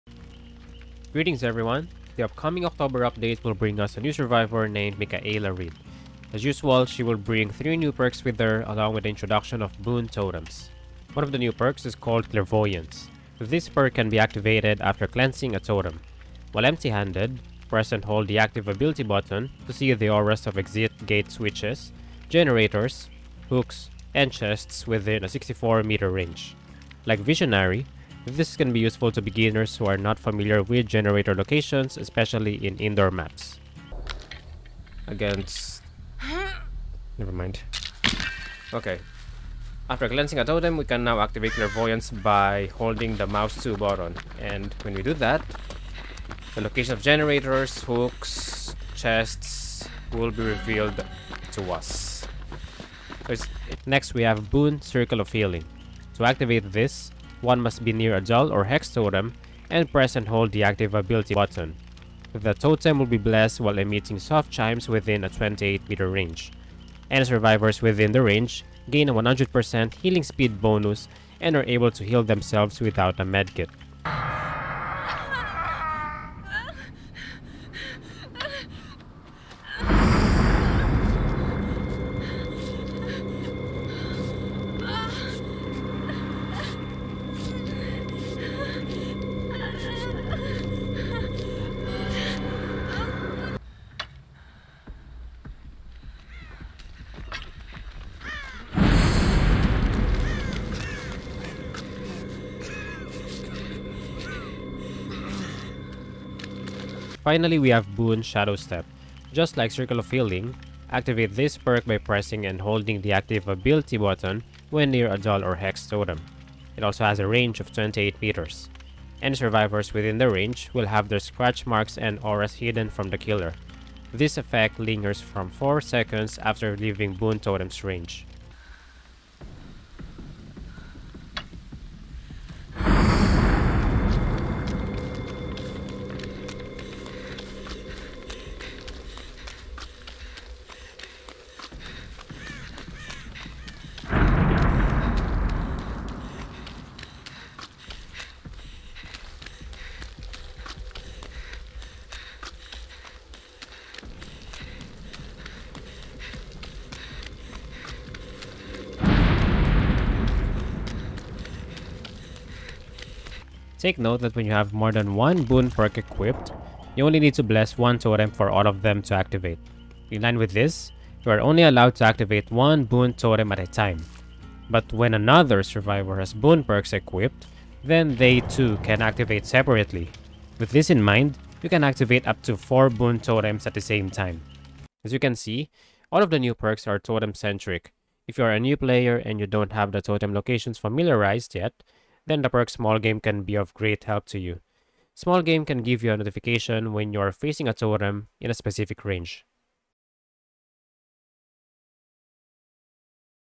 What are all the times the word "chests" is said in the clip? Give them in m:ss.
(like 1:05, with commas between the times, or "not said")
0:24, 0:48.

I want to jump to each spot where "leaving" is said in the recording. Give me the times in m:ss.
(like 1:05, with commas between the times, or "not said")
2:06.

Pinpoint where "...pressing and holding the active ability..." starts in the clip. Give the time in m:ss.
1:51.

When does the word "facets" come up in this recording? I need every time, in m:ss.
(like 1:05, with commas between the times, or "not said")
not said.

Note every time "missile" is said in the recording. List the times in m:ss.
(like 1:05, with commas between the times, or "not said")
not said.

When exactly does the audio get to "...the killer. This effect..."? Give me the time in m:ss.
2:03.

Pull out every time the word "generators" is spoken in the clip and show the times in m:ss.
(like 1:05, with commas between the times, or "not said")
0:22, 0:30, 0:47.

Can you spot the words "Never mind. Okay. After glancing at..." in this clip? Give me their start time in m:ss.
0:37.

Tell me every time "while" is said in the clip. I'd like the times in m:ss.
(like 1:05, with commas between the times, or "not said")
0:16, 1:03.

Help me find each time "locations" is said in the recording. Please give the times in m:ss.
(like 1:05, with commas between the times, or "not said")
0:31, 0:46, 3:10.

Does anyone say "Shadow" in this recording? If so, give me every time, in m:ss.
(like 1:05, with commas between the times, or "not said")
1:48.